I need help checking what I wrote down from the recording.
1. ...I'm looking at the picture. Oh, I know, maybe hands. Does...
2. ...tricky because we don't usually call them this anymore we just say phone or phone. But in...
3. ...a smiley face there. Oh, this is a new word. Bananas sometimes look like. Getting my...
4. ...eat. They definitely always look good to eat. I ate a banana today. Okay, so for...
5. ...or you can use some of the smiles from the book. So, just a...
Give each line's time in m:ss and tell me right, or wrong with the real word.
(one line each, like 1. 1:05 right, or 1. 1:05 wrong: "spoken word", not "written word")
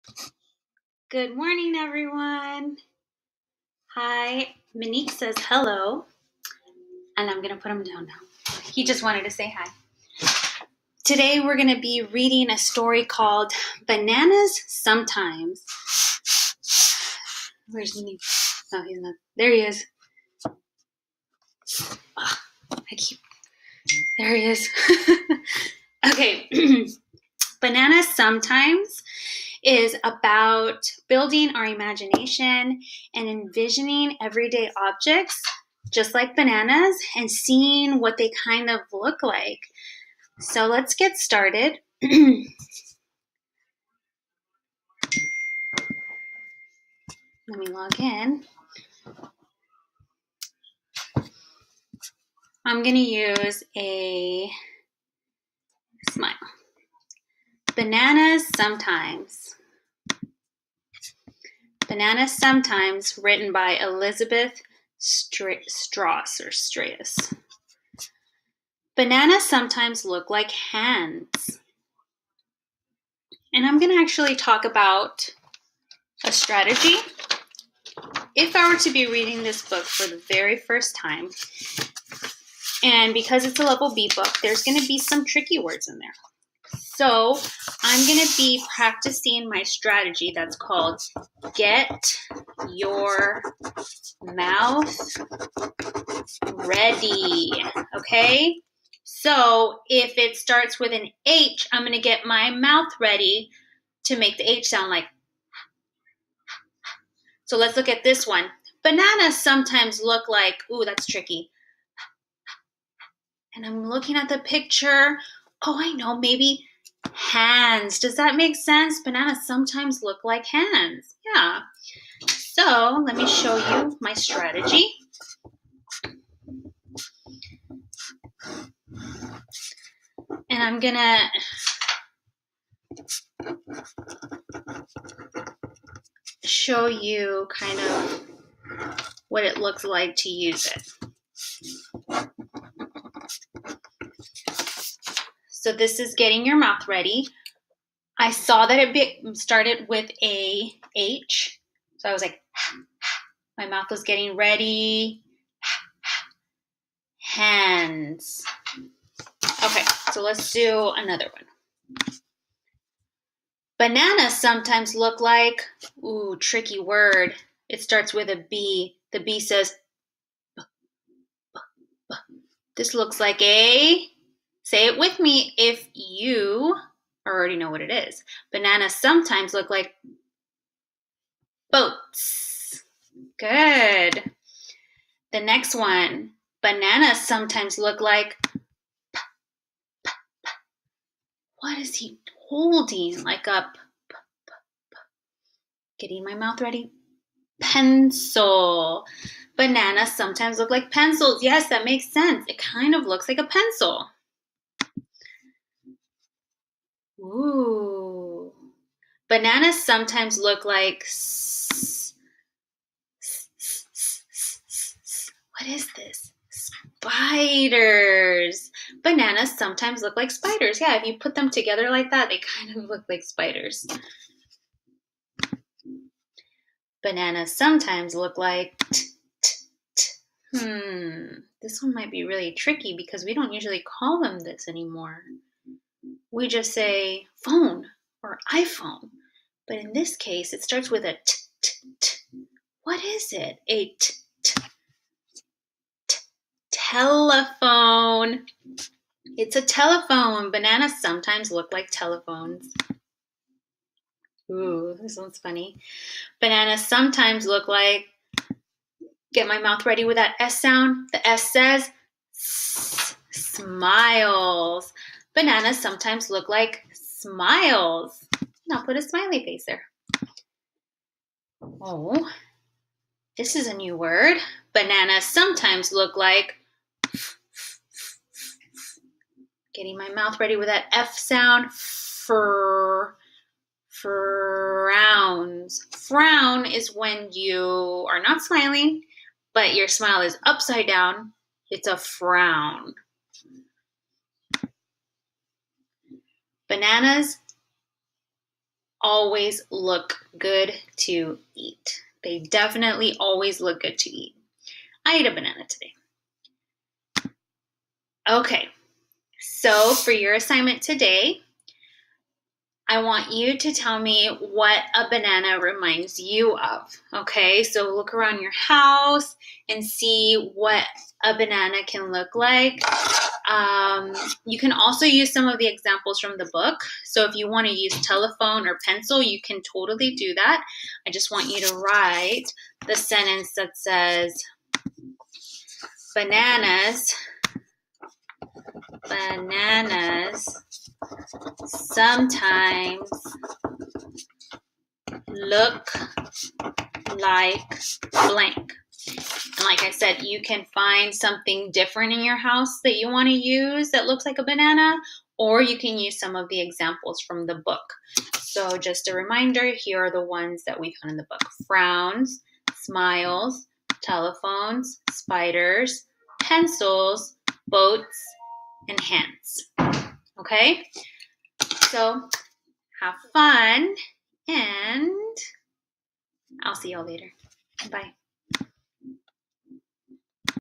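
1. 1:53 right
2. 3:52 wrong: "iPhone", not "phone"
3. 4:28 right
4. 5:01 right
5. 5:55 wrong: "examples", not "smiles".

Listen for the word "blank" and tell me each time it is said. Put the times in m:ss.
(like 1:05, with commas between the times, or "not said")
5:48.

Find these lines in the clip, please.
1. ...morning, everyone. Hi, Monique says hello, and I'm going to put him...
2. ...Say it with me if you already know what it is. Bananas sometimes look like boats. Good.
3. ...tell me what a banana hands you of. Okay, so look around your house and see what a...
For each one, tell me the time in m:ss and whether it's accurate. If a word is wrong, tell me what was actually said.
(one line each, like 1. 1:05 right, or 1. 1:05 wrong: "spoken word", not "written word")
1. 0:01 right
2. 2:54 right
3. 5:13 wrong: "reminds", not "hands".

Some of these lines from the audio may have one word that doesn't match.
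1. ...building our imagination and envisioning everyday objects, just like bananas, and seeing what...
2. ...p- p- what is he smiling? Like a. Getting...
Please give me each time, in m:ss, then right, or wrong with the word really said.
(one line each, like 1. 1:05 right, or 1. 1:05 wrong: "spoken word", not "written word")
1. 0:31 right
2. 3:09 wrong: "holding", not "smiling".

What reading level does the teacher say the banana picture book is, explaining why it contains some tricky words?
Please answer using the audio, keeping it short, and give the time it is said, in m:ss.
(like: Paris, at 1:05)
level B, at 1:23.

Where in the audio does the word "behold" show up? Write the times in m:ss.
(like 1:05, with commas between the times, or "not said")
not said.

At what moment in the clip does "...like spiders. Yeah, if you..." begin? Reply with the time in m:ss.
3:40.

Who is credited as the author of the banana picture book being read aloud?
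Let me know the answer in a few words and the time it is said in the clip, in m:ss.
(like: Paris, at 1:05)
Elizabeth Strauss, at 1:03.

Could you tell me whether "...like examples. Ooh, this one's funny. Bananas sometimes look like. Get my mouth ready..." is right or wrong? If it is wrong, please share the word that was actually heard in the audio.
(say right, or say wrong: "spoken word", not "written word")
wrong: "telephones", not "examples".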